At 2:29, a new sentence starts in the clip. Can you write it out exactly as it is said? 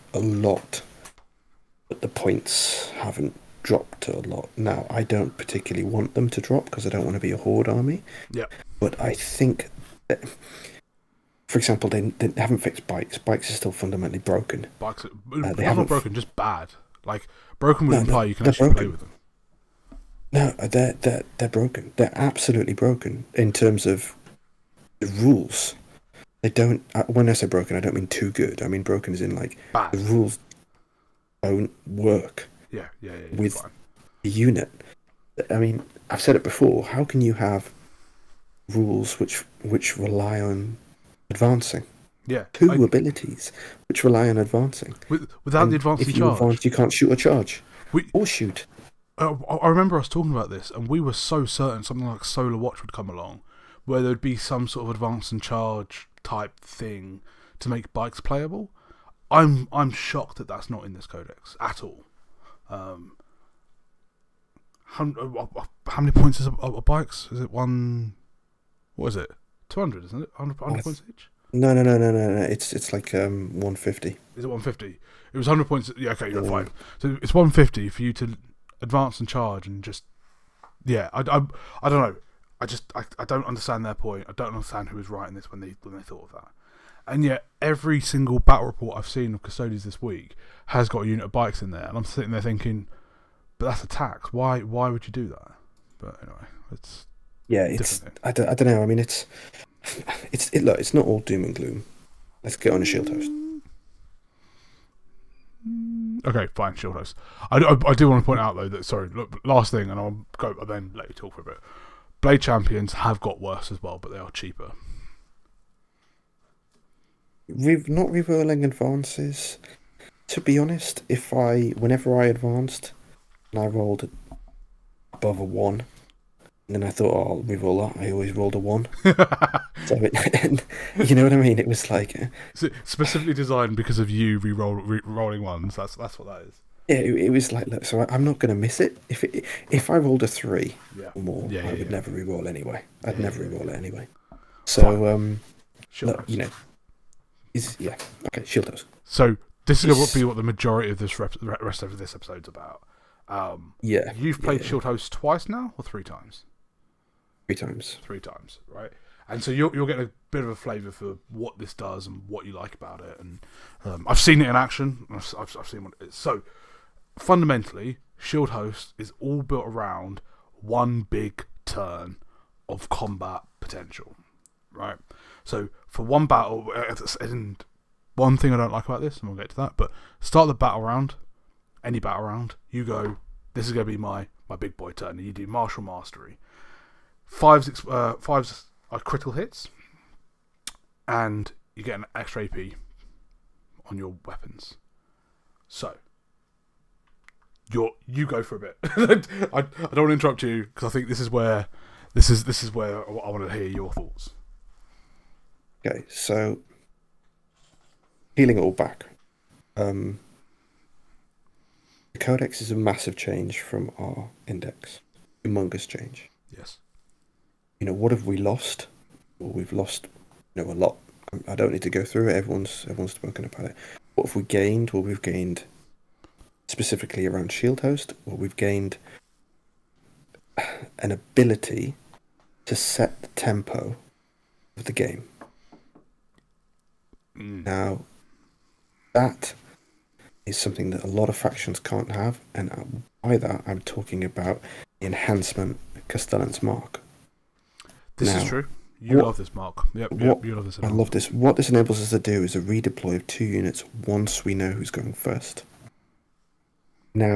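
So this is going to be what the majority of this rest of this episode's about.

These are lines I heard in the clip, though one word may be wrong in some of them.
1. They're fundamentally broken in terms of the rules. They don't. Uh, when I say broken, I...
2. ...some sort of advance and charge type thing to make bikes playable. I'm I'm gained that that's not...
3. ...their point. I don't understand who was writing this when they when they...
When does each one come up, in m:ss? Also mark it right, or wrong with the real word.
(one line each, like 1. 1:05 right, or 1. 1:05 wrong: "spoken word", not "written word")
1. 0:21 wrong: "absolutely", not "fundamentally"
2. 0:54 wrong: "shocked", not "gained"
3. 1:23 right.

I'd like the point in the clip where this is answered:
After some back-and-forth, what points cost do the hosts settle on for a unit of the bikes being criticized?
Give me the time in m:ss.
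1:12.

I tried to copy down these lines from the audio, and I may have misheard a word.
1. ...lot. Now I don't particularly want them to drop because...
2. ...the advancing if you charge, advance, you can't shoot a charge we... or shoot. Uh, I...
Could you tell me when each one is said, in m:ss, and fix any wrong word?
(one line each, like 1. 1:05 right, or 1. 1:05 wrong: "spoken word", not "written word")
1. 0:04 right
2. 0:45 right.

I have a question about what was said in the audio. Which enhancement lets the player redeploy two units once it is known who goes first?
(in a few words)
Castellan's Mark.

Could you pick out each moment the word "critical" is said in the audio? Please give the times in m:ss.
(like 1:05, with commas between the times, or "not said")
3:08.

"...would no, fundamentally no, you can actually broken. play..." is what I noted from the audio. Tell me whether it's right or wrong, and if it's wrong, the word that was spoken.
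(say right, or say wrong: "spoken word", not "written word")
wrong: "imply", not "fundamentally".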